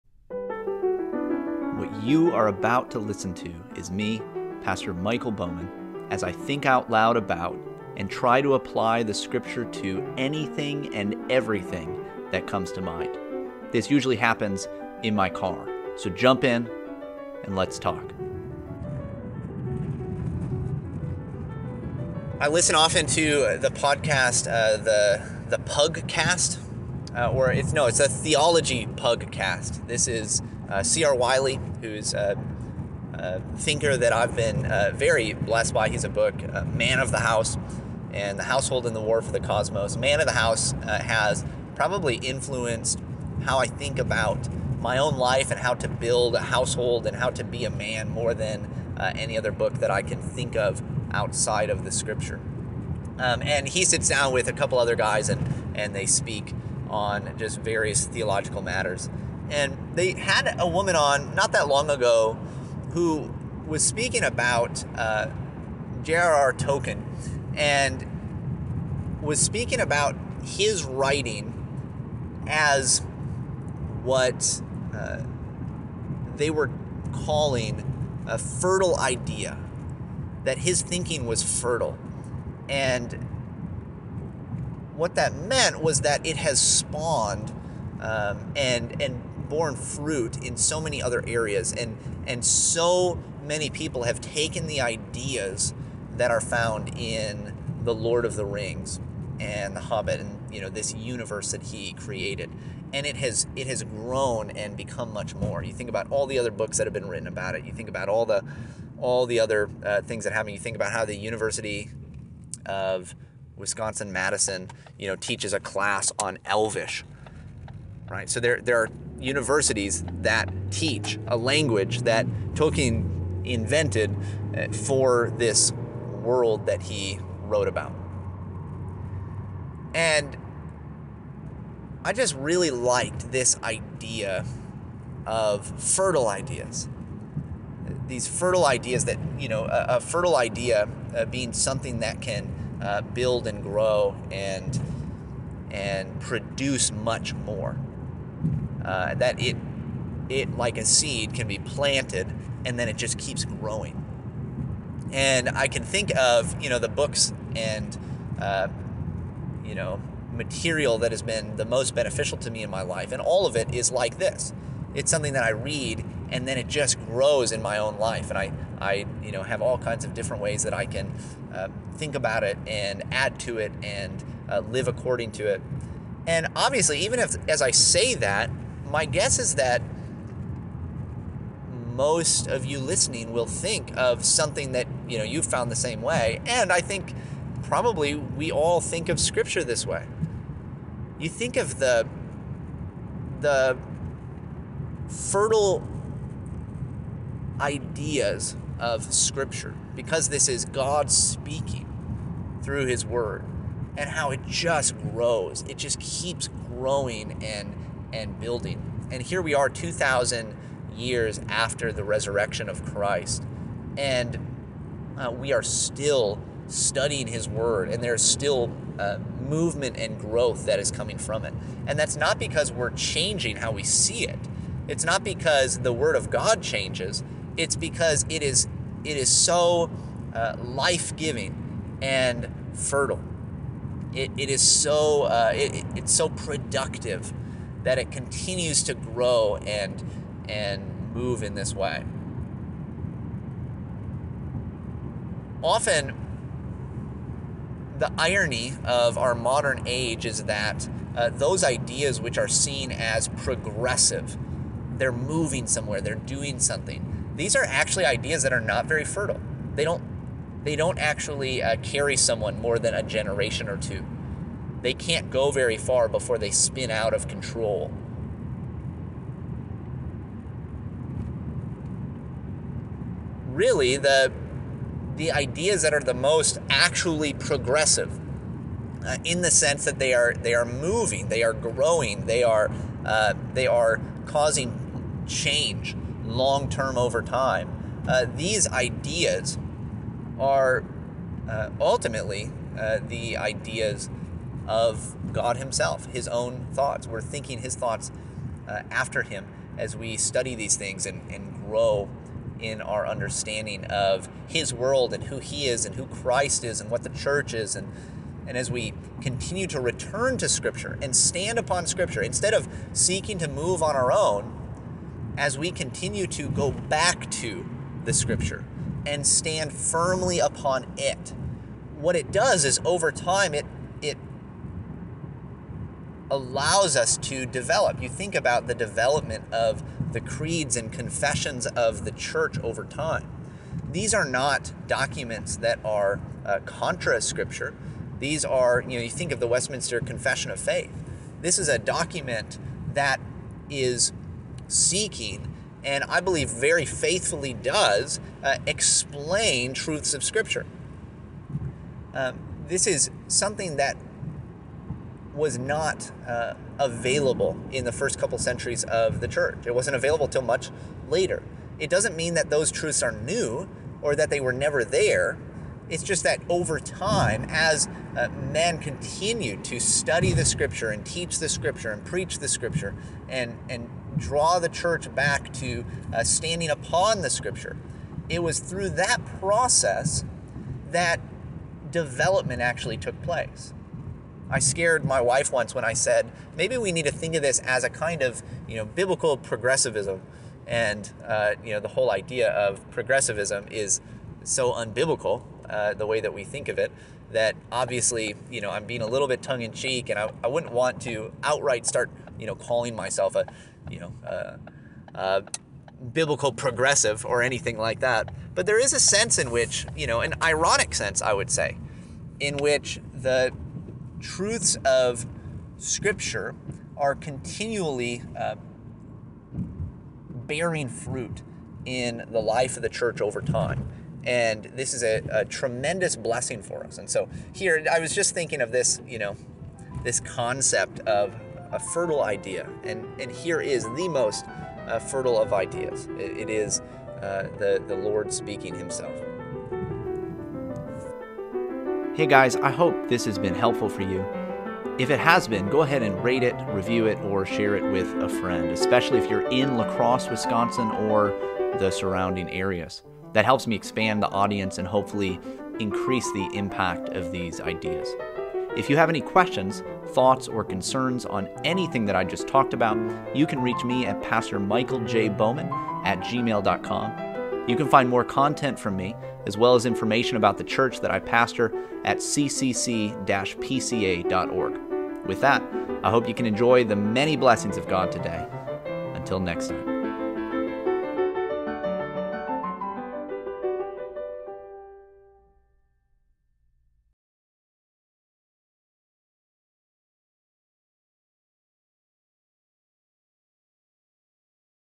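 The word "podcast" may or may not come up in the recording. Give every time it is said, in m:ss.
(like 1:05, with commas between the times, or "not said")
0:23.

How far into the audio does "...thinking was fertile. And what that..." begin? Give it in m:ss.
1:20.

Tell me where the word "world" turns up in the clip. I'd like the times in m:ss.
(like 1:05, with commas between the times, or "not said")
2:06, 5:04.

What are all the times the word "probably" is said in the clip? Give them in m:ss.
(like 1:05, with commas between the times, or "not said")
0:41, 3:07.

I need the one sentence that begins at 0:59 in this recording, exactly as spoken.
And they had a woman on not that long ago who was speaking about uh, J.R.R.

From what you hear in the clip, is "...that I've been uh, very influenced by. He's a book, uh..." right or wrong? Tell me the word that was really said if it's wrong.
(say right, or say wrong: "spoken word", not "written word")
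wrong: "blessed", not "influenced".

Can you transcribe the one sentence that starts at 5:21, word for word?
What it does is over time it it allows us to develop.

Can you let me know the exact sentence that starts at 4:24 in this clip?
They can't go very far before they spin out of control.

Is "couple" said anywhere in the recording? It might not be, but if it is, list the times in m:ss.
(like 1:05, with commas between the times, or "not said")
0:54, 5:58.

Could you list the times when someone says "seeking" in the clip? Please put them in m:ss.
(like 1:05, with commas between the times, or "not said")
5:12, 5:44.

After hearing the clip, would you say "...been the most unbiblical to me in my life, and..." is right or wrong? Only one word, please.
wrong.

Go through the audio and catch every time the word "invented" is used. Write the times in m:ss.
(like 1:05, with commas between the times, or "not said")
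2:03.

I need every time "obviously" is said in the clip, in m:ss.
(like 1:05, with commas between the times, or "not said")
2:56, 6:37.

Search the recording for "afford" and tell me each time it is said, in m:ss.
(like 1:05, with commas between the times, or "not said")
not said.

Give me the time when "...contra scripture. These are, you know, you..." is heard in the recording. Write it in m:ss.
5:36.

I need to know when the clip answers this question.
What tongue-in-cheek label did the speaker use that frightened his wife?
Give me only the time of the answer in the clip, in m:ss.
6:28.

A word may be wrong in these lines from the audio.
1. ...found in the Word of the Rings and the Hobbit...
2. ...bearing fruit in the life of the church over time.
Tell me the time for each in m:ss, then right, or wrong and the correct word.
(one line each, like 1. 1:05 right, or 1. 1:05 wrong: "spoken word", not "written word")
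1. 1:36 wrong: "Lord", not "Word"
2. 6:59 right.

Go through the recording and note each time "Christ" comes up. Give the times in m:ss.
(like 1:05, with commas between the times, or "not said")
3:32, 5:06.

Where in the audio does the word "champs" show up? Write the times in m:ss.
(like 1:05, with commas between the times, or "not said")
not said.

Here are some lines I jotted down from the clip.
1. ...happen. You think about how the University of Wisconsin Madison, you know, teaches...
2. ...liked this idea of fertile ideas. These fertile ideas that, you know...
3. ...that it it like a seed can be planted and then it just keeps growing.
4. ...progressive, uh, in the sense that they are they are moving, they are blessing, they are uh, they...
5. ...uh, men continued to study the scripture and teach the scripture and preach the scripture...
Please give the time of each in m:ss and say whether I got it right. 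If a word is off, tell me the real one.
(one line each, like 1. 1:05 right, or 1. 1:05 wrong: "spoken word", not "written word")
1. 1:50 right
2. 2:12 right
3. 2:29 right
4. 4:37 wrong: "growing", not "blessing"
5. 6:08 right.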